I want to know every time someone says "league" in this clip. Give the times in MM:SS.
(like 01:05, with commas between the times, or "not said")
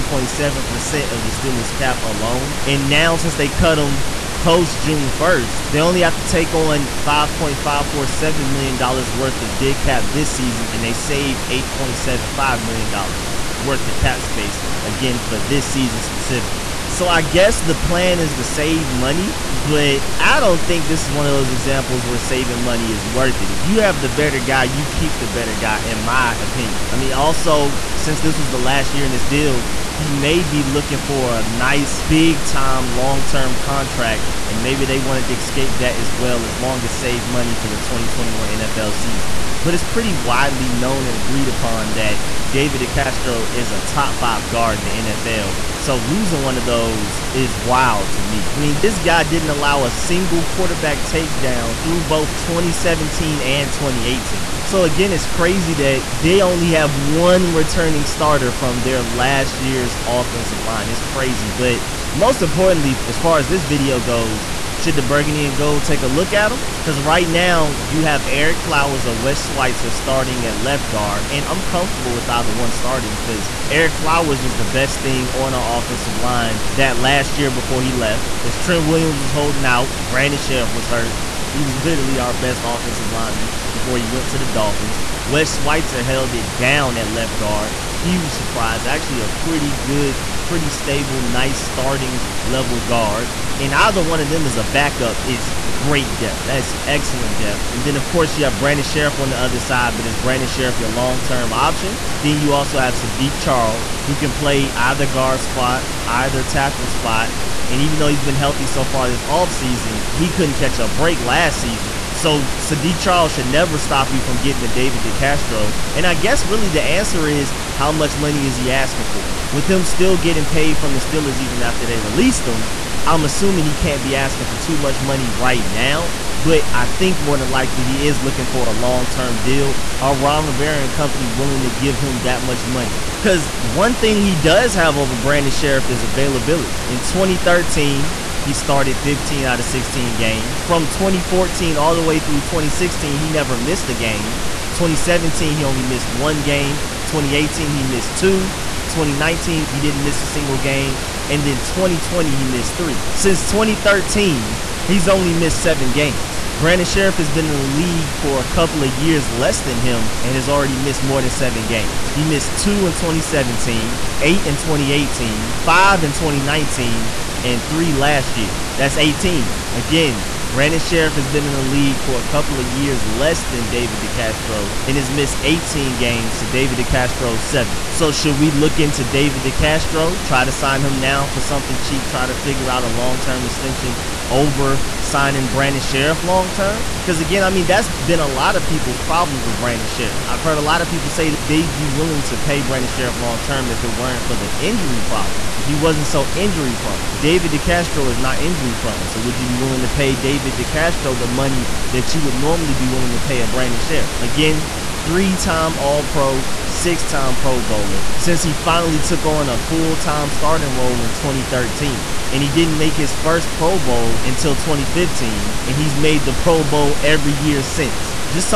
02:37, 02:51.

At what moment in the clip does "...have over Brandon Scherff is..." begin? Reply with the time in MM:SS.
02:14.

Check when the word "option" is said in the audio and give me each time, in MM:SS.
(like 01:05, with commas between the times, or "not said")
01:41.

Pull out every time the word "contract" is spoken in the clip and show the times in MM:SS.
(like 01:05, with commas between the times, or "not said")
00:33.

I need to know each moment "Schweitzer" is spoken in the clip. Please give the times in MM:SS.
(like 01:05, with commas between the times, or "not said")
01:09, 01:25.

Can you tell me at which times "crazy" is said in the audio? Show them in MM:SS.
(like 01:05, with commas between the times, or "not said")
00:55, 01:01.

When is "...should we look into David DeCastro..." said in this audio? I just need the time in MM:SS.
02:58.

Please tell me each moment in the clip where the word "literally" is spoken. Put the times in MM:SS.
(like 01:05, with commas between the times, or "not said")
01:21.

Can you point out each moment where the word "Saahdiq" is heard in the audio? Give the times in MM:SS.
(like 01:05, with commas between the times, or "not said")
01:42, 01:52.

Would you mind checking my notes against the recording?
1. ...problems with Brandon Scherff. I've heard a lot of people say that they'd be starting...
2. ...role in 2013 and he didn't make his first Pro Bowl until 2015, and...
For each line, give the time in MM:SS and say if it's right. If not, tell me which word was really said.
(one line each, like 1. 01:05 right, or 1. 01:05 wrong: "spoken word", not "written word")
1. 03:08 wrong: "willing", not "starting"
2. 03:30 right.